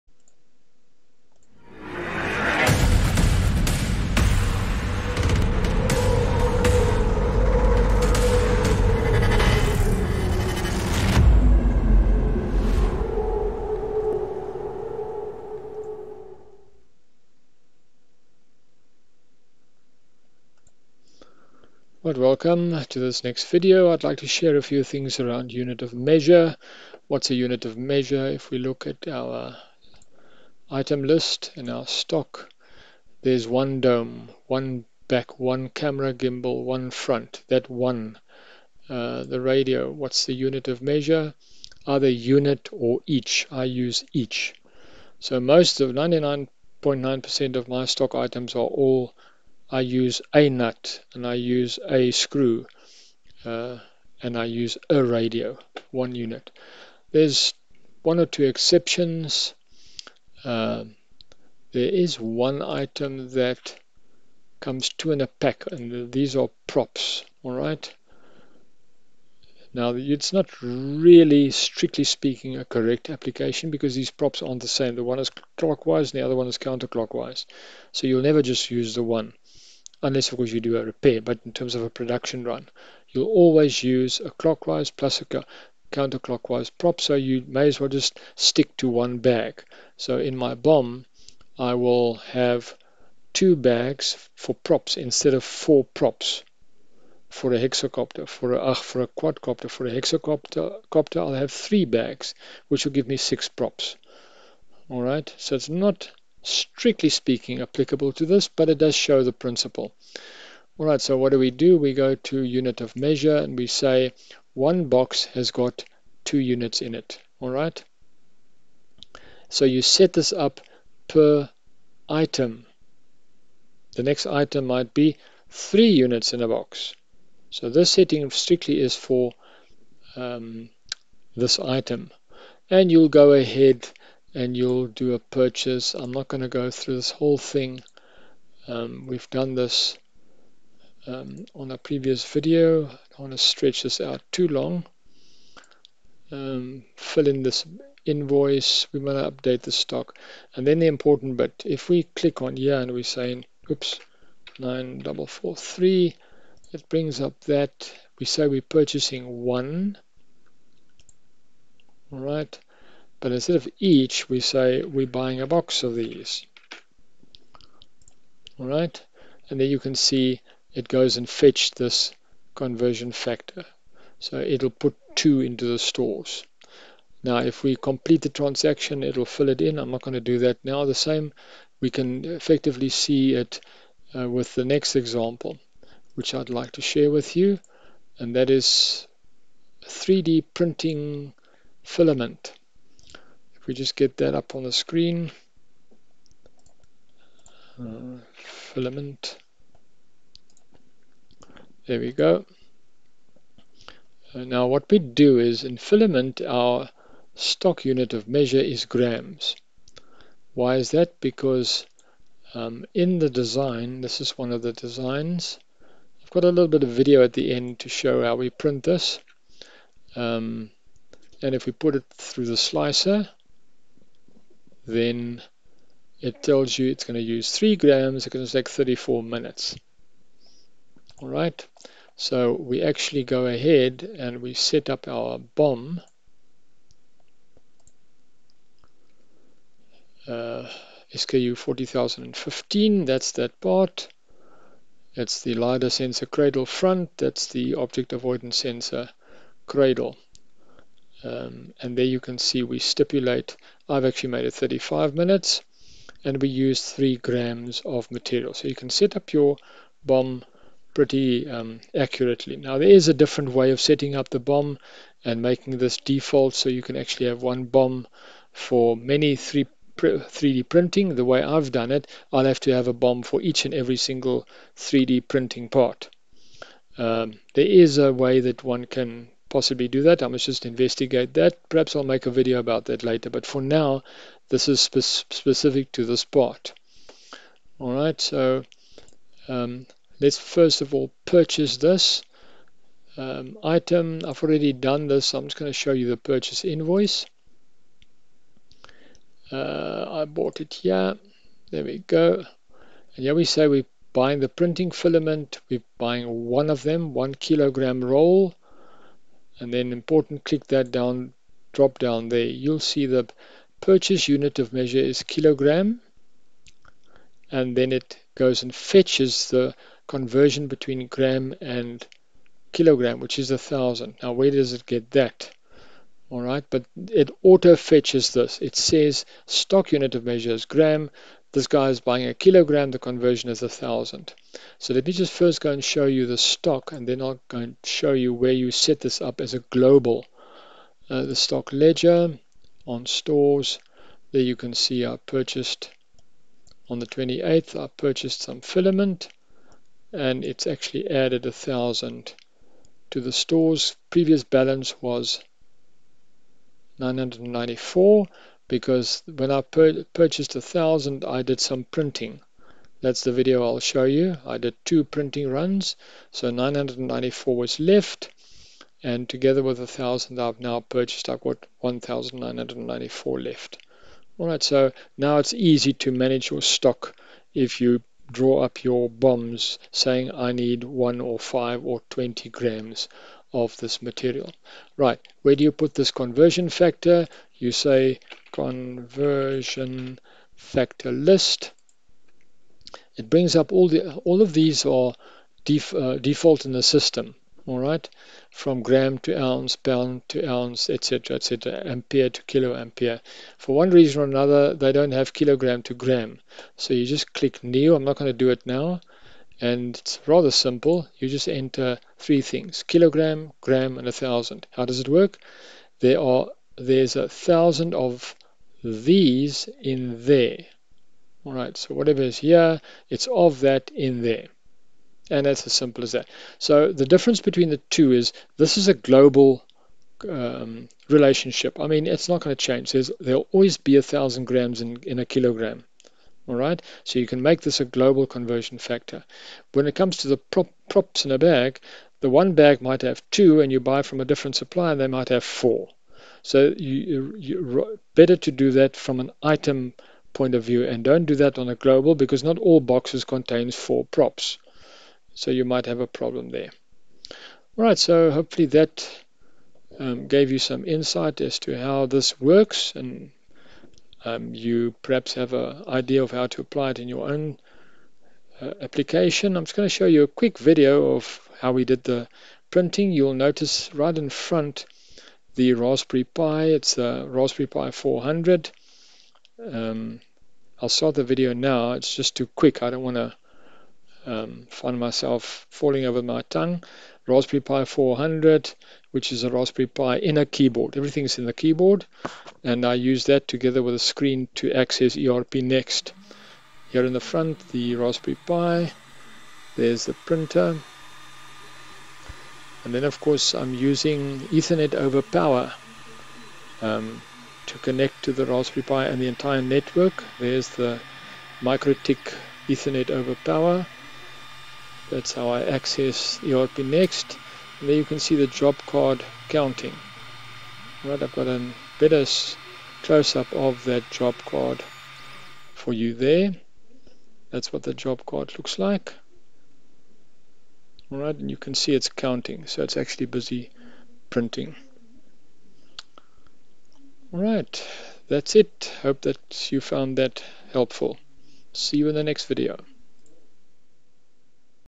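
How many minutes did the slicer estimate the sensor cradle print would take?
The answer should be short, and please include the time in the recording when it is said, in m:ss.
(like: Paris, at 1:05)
34, at 3:48.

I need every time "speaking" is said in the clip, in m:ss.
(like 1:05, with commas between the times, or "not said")
1:12, 1:47.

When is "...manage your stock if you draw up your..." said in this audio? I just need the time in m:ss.
6:16.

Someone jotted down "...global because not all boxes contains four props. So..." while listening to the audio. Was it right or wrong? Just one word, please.
right.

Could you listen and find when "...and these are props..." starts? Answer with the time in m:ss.
1:05.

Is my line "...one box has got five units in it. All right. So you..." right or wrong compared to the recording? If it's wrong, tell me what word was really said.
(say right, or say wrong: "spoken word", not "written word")
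wrong: "two", not "five".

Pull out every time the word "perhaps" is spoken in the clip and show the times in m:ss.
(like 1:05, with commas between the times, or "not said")
4:41, 7:45.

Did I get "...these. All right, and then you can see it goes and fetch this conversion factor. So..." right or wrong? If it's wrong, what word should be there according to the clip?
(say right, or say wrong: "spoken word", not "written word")
right.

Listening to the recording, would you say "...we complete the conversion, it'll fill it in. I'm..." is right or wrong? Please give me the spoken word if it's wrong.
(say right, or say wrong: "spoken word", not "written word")
wrong: "transaction", not "conversion".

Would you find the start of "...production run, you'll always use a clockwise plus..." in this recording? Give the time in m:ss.
1:21.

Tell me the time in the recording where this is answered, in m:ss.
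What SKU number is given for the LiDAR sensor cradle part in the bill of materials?
4:01.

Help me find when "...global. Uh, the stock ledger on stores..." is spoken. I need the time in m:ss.
5:39.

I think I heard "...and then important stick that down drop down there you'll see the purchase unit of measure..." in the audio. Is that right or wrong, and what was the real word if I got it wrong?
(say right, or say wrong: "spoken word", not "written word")
wrong: "click", not "stick".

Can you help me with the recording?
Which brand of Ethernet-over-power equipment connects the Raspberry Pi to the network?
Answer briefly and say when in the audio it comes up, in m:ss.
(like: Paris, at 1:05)
MikroTik, at 8:31.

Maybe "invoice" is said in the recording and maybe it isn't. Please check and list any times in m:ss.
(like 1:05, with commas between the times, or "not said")
2:28, 4:56.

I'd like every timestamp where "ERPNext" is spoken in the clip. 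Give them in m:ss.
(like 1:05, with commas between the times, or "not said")
8:15, 8:36.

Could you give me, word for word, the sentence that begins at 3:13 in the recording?
If we just get that up on the screen, uh, filament, there we go.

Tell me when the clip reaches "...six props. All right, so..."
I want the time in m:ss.
1:43.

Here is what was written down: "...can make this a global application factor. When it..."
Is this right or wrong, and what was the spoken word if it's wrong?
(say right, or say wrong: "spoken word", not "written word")
wrong: "conversion", not "application".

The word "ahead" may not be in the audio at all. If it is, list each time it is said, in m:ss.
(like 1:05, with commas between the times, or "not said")
2:13, 3:53.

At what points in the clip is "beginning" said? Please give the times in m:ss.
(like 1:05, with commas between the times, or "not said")
not said.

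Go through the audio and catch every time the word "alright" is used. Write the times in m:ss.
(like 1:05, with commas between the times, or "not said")
3:51, 6:14.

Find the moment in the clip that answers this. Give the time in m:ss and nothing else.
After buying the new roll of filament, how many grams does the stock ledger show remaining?
6:11.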